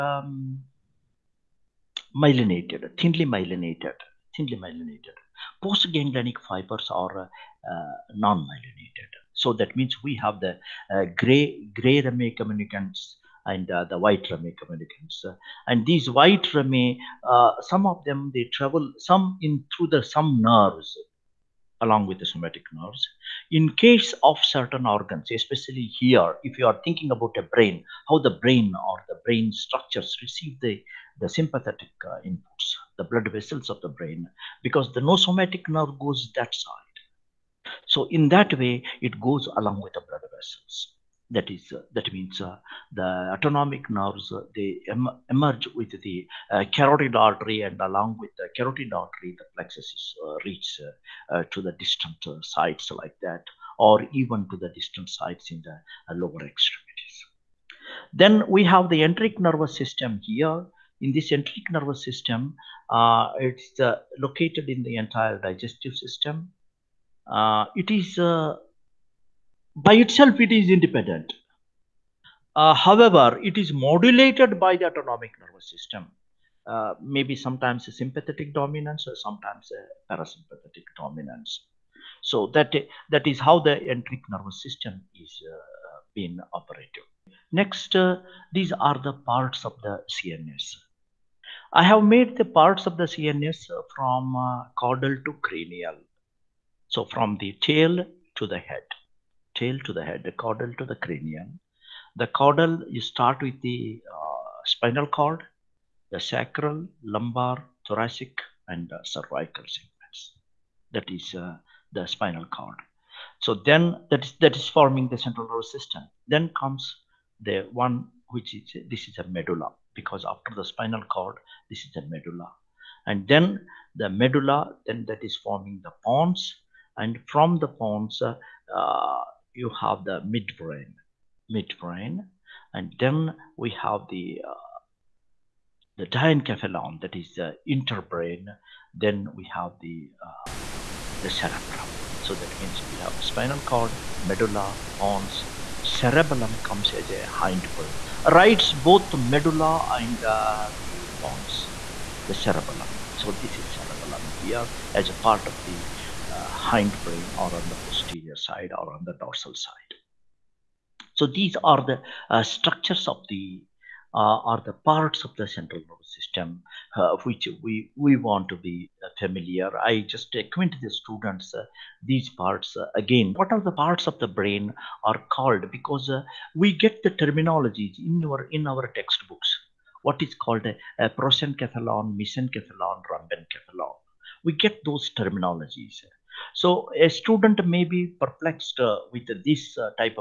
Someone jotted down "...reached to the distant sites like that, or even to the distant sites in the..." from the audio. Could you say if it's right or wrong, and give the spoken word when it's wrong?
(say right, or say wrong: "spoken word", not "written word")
right.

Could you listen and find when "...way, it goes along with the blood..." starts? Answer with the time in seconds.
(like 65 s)
38 s.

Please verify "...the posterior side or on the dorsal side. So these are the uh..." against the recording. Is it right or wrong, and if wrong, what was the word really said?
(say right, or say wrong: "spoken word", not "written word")
right.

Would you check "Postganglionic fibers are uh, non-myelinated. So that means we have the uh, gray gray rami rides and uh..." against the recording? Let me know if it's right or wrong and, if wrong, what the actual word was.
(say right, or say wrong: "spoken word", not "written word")
wrong: "communicantes", not "rides".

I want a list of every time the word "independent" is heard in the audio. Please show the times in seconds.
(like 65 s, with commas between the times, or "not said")
70 s.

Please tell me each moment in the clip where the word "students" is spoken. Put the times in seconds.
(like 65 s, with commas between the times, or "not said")
170 s, 187 s.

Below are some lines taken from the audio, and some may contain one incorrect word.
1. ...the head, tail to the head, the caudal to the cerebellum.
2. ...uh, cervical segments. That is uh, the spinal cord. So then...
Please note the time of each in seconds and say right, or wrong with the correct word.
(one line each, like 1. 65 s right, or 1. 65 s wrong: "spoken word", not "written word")
1. 98 s wrong: "cranium", not "cerebellum"
2. 108 s right.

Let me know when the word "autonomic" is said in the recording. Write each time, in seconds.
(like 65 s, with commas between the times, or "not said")
43 s, 74 s.